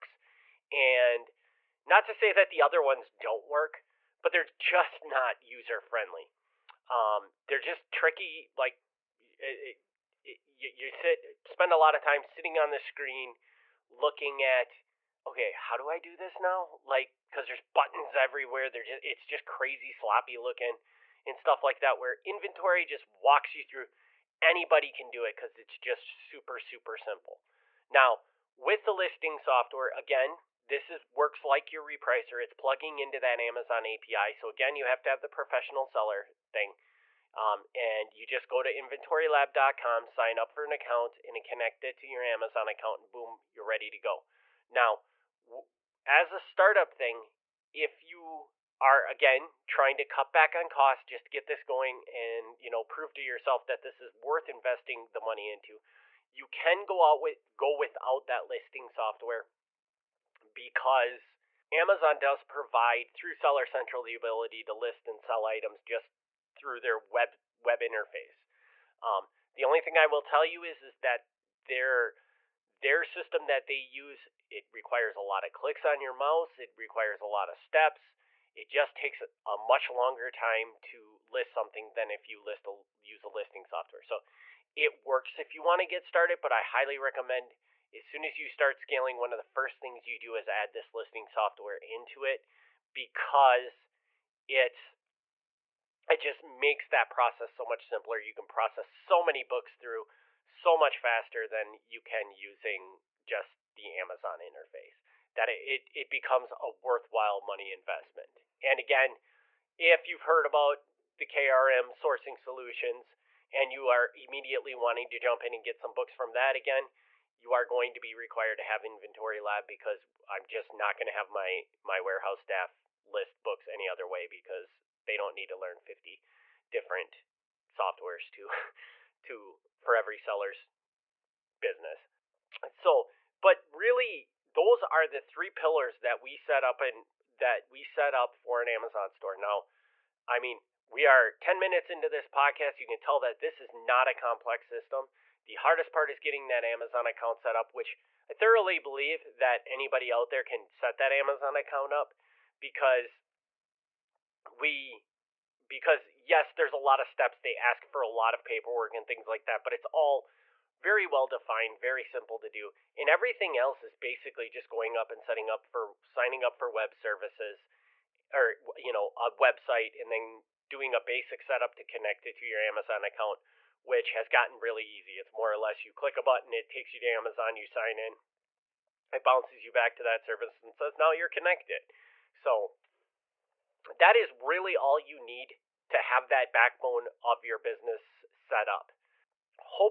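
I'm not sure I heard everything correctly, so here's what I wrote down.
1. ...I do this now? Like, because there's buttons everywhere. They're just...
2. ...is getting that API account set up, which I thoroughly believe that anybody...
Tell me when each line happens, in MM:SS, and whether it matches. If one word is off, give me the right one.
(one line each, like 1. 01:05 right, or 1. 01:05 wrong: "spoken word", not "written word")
1. 00:15 right
2. 02:26 wrong: "Amazon", not "API".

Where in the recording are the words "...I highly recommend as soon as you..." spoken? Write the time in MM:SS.
01:26.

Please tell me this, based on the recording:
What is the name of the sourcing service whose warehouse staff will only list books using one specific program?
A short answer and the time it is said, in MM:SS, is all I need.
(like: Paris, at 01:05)
KRM sourcing solutions, at 01:51.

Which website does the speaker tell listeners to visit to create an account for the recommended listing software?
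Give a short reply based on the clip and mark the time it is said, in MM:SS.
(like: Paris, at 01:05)
inventorylab.com, at 00:38.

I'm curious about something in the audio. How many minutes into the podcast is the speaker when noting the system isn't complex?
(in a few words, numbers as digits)
10.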